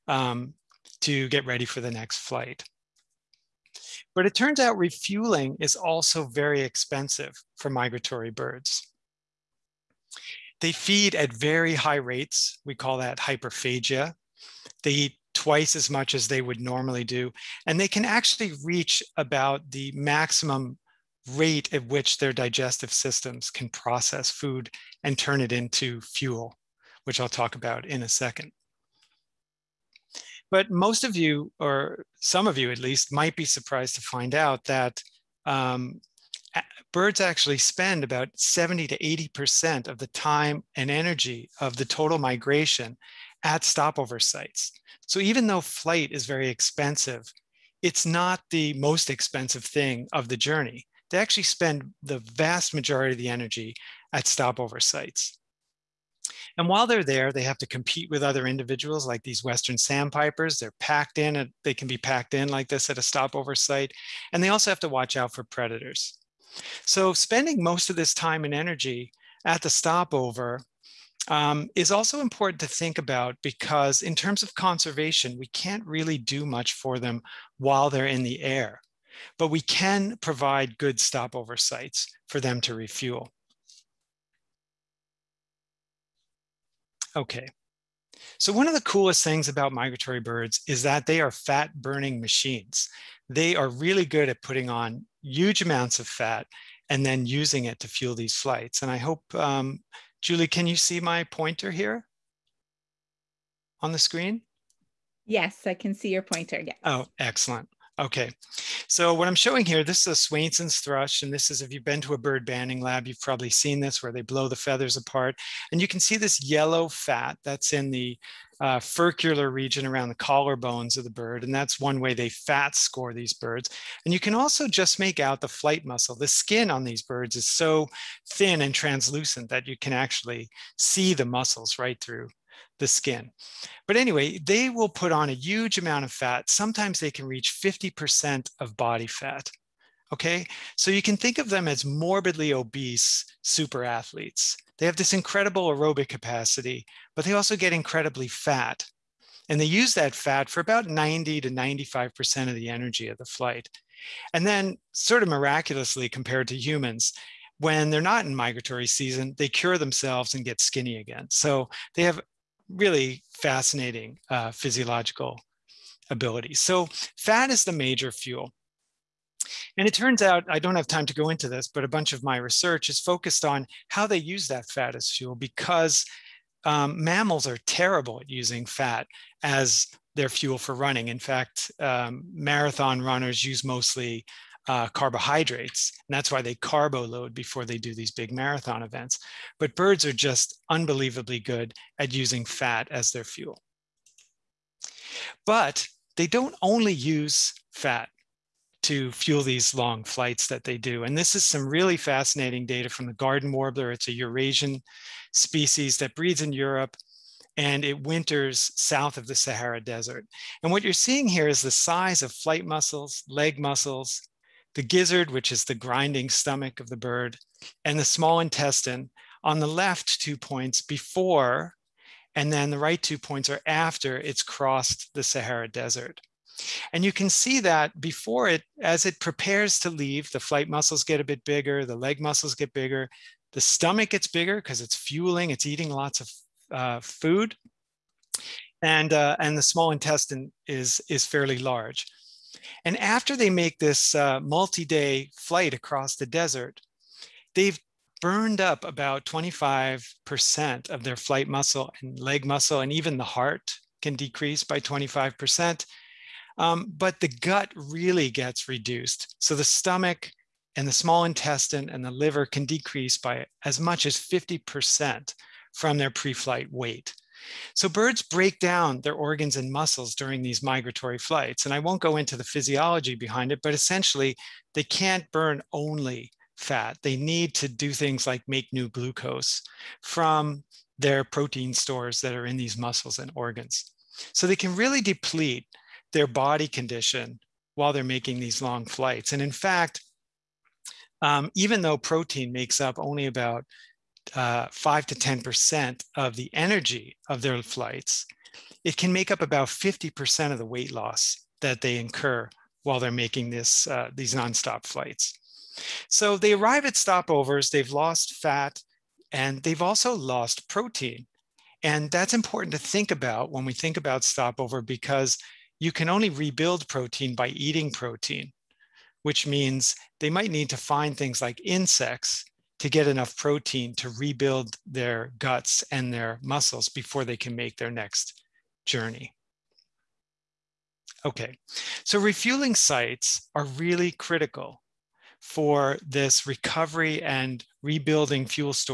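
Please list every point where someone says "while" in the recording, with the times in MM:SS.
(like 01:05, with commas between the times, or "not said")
00:56, 01:17, 04:47, 05:02.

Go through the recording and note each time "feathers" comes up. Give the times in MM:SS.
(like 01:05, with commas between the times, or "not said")
01:54.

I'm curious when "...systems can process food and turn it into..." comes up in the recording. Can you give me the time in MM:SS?
00:22.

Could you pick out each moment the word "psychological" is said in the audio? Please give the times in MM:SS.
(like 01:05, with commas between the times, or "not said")
not said.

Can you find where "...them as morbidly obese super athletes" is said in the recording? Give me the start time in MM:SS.
02:21.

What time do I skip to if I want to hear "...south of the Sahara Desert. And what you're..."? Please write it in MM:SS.
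03:28.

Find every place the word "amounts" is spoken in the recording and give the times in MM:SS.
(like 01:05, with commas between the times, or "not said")
01:35, 02:15.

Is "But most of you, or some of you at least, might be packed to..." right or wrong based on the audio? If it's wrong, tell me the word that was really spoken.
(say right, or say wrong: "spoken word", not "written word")
wrong: "surprised", not "packed".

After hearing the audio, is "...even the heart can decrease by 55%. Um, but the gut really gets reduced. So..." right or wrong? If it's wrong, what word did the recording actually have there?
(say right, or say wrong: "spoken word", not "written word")
wrong: "25", not "55".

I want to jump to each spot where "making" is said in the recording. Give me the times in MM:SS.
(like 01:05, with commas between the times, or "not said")
04:48, 05:03.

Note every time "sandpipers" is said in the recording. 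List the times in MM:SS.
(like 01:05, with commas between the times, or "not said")
00:59.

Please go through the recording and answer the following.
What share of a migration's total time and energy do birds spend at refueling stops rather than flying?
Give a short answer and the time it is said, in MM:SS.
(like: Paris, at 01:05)
70 to 80%, at 00:38.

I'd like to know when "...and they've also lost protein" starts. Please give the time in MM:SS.
05:09.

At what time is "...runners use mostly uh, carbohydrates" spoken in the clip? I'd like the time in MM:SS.
03:03.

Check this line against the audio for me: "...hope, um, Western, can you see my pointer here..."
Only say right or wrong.
wrong.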